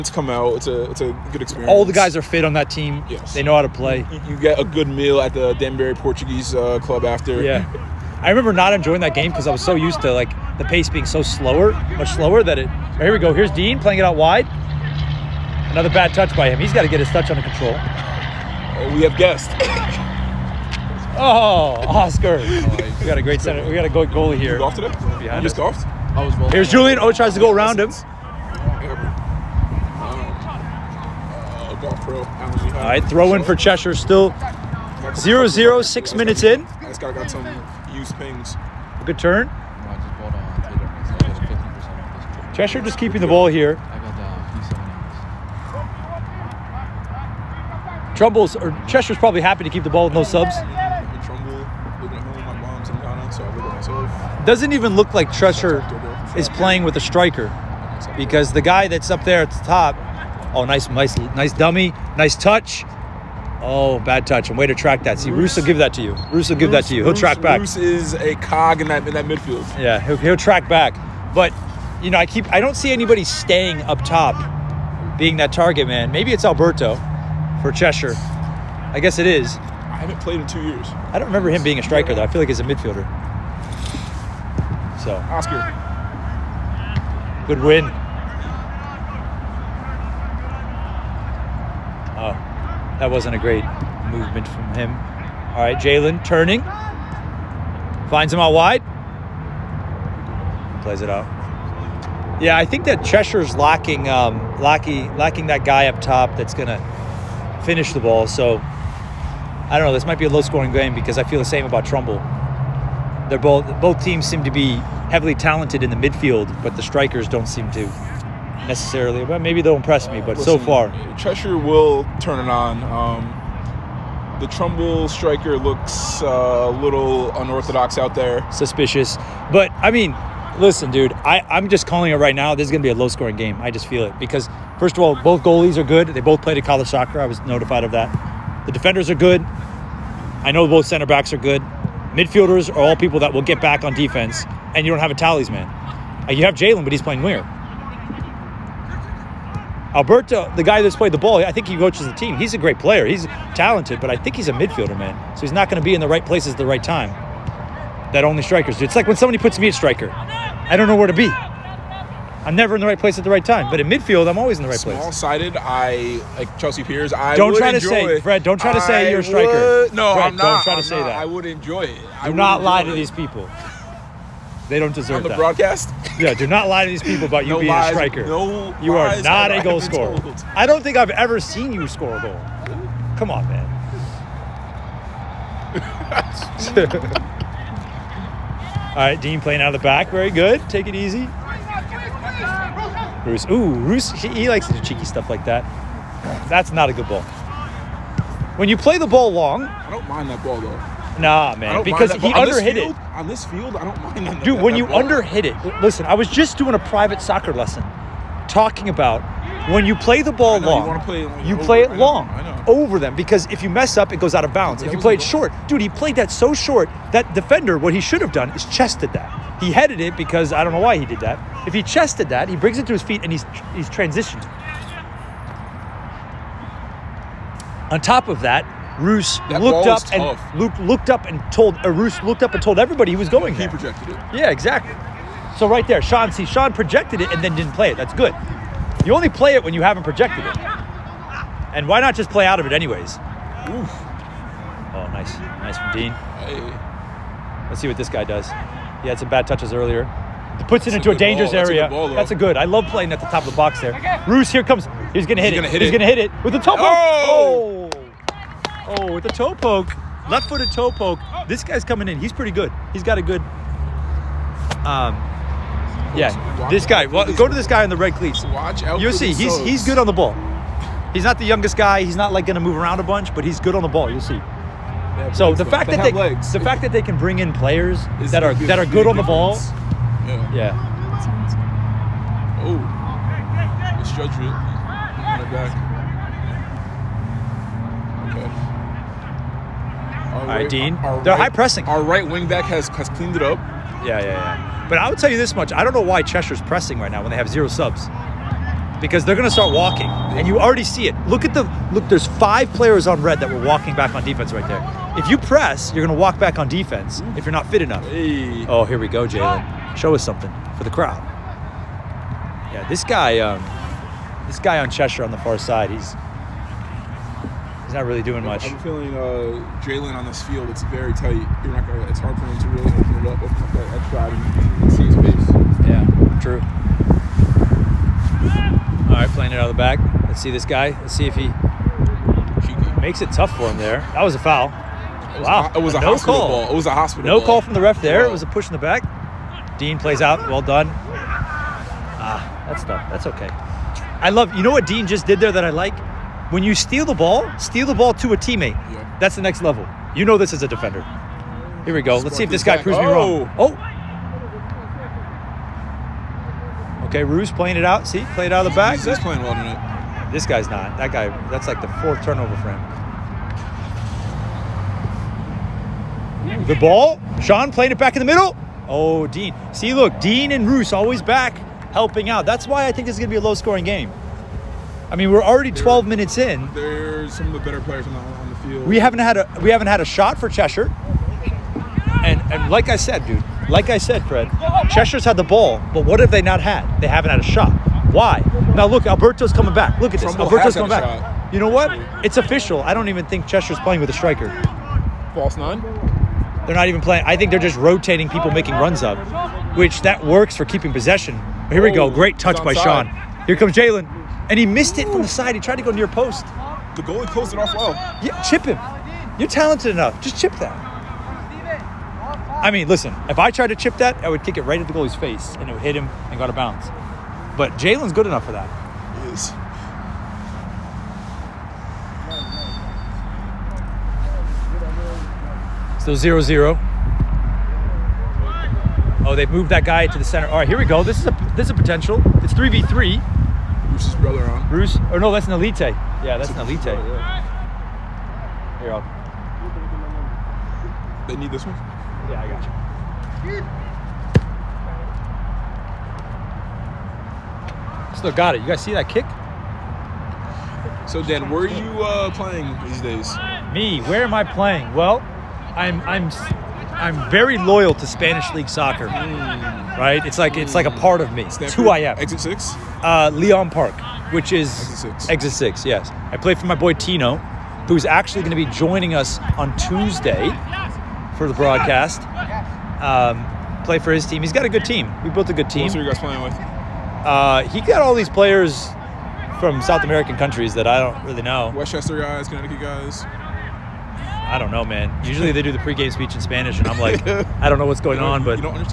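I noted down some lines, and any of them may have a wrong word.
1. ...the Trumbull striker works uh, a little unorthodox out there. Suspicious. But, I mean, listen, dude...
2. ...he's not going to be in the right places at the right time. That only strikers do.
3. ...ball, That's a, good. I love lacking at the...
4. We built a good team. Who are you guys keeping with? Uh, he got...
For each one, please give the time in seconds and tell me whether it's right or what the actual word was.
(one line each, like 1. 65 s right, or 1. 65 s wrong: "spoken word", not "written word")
1. 124 s wrong: "looks", not "works"
2. 155 s right
3. 251 s wrong: "playing", not "lacking"
4. 475 s wrong: "playing", not "keeping".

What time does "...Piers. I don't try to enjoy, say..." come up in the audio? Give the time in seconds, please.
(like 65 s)
166 s.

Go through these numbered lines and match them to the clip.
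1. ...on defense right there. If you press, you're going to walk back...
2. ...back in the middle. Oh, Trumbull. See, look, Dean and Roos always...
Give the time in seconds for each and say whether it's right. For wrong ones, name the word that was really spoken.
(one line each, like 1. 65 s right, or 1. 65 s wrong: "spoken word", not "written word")
1. 304 s right
2. 367 s wrong: "Dean", not "Trumbull".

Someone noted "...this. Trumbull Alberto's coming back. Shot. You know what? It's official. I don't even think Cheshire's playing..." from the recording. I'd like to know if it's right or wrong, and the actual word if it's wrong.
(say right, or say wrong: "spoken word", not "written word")
right.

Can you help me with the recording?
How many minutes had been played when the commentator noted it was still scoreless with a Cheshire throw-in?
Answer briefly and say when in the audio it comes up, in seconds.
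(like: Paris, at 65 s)
6, at 35 s.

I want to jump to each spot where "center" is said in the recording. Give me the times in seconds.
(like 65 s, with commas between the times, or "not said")
23 s, 140 s, 430 s.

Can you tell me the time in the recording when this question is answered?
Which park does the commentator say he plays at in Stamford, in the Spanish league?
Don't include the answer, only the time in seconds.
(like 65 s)
463 s.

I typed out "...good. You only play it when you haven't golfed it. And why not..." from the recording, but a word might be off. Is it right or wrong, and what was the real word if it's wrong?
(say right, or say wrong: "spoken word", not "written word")
wrong: "projected", not "golfed".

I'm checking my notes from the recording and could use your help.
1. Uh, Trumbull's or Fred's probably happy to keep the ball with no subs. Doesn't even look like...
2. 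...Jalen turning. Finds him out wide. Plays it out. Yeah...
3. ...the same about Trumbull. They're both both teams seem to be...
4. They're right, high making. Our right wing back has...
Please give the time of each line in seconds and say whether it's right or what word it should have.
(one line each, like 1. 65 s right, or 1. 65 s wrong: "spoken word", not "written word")
1. 43 s wrong: "Cheshire", not "Fred"
2. 95 s right
3. 111 s right
4. 291 s wrong: "pressing", not "making".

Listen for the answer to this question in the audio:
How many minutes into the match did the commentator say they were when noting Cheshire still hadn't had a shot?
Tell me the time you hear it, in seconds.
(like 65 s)
375 s.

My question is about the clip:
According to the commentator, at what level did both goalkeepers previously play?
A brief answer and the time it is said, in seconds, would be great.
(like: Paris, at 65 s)
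College soccer, at 136 s.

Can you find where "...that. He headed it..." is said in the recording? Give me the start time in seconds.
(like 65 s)
219 s.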